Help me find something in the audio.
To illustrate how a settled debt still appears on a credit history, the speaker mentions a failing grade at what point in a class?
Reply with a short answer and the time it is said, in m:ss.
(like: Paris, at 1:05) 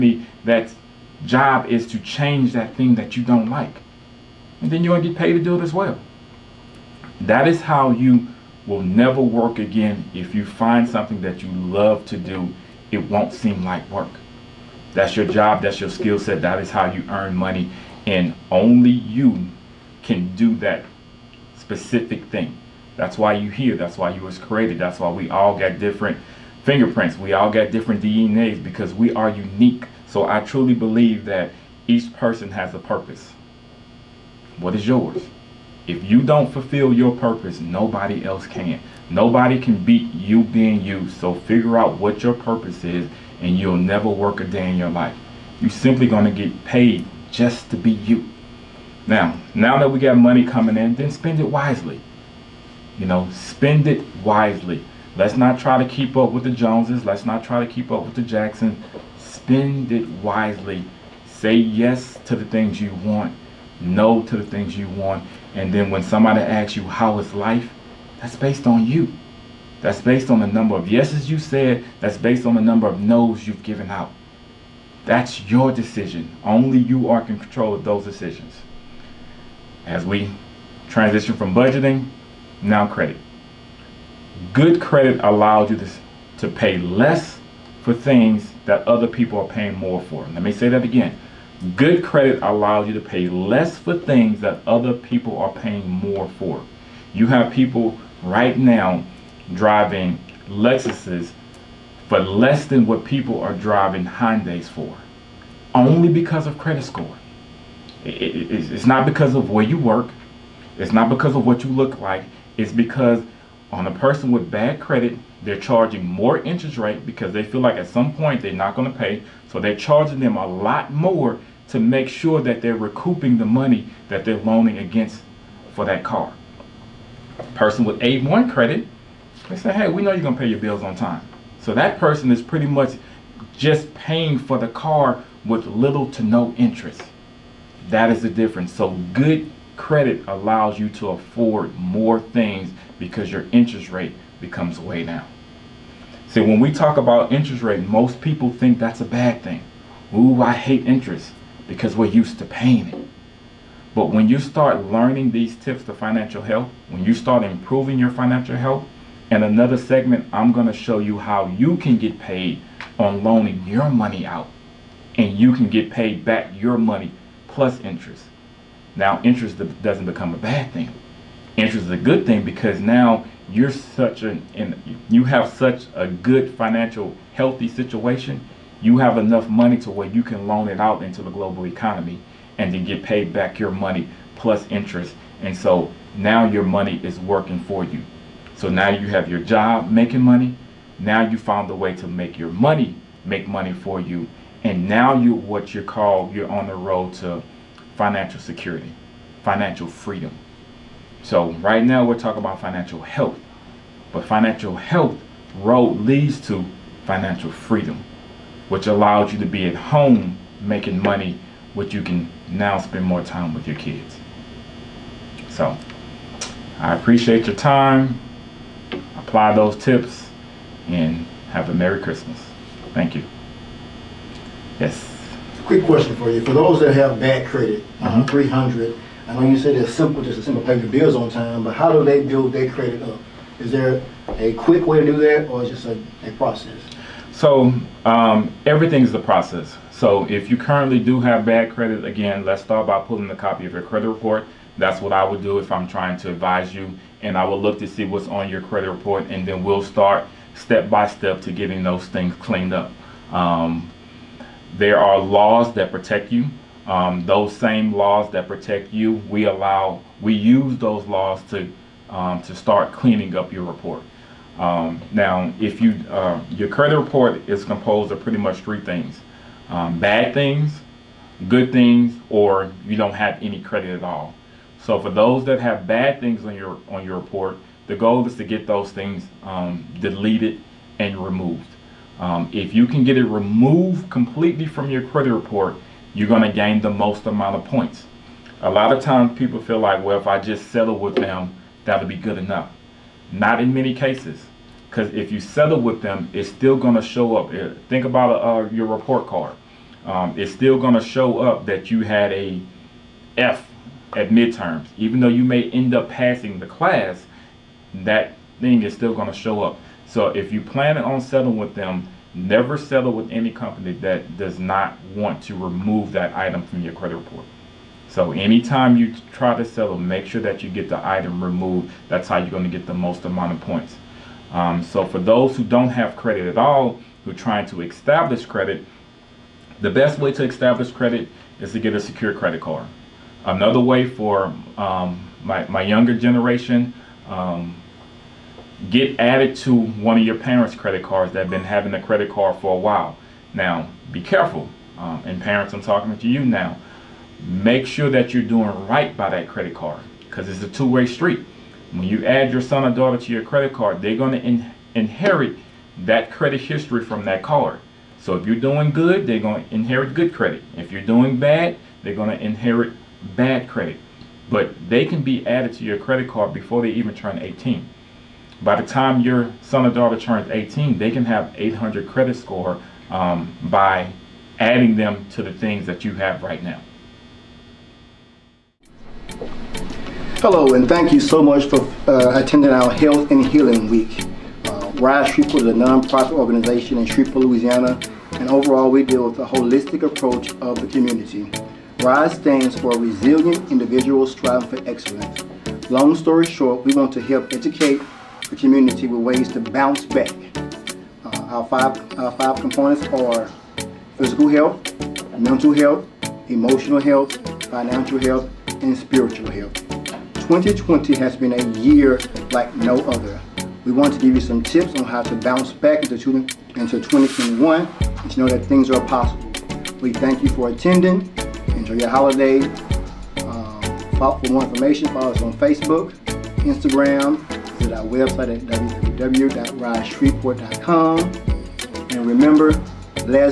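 Midterms, at 5:04.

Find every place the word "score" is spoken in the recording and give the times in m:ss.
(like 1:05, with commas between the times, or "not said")
1:46, 6:12.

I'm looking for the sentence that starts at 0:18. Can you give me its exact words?
And only you can do that specific thing.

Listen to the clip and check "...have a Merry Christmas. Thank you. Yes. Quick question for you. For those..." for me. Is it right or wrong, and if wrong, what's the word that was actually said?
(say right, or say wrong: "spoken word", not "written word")
right.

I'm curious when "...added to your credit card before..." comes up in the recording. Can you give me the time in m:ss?
6:05.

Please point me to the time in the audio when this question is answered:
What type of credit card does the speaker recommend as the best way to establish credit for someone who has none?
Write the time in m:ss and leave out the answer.
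5:32.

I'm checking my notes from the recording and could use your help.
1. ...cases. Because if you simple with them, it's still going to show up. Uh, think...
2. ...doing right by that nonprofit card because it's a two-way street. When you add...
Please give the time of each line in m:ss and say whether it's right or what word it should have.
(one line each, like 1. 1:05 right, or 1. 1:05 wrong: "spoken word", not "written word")
1. 4:53 wrong: "settle", not "simple"
2. 5:48 wrong: "credit", not "nonprofit".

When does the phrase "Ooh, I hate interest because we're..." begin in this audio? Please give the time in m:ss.
2:30.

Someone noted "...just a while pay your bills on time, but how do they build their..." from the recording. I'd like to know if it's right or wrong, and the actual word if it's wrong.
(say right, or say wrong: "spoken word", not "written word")
wrong: "simple", not "while".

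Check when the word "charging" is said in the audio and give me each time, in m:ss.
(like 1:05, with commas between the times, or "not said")
1:55, 1:59.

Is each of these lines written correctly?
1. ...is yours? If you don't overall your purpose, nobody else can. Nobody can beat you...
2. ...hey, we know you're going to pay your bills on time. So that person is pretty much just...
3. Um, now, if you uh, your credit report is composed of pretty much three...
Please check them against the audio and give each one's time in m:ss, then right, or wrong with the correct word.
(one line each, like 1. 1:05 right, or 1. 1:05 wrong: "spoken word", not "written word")
1. 0:34 wrong: "fulfill", not "overall"
2. 2:09 right
3. 4:24 right.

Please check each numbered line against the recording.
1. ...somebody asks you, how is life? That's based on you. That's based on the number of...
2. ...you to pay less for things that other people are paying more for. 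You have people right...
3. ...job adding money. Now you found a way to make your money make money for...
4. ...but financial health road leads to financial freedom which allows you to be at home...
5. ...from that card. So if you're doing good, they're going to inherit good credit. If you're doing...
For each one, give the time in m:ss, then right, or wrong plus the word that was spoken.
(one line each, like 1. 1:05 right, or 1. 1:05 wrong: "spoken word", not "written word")
1. 1:06 right
2. 1:32 right
3. 3:09 wrong: "making", not "adding"
4. 3:24 right
5. 5:57 right.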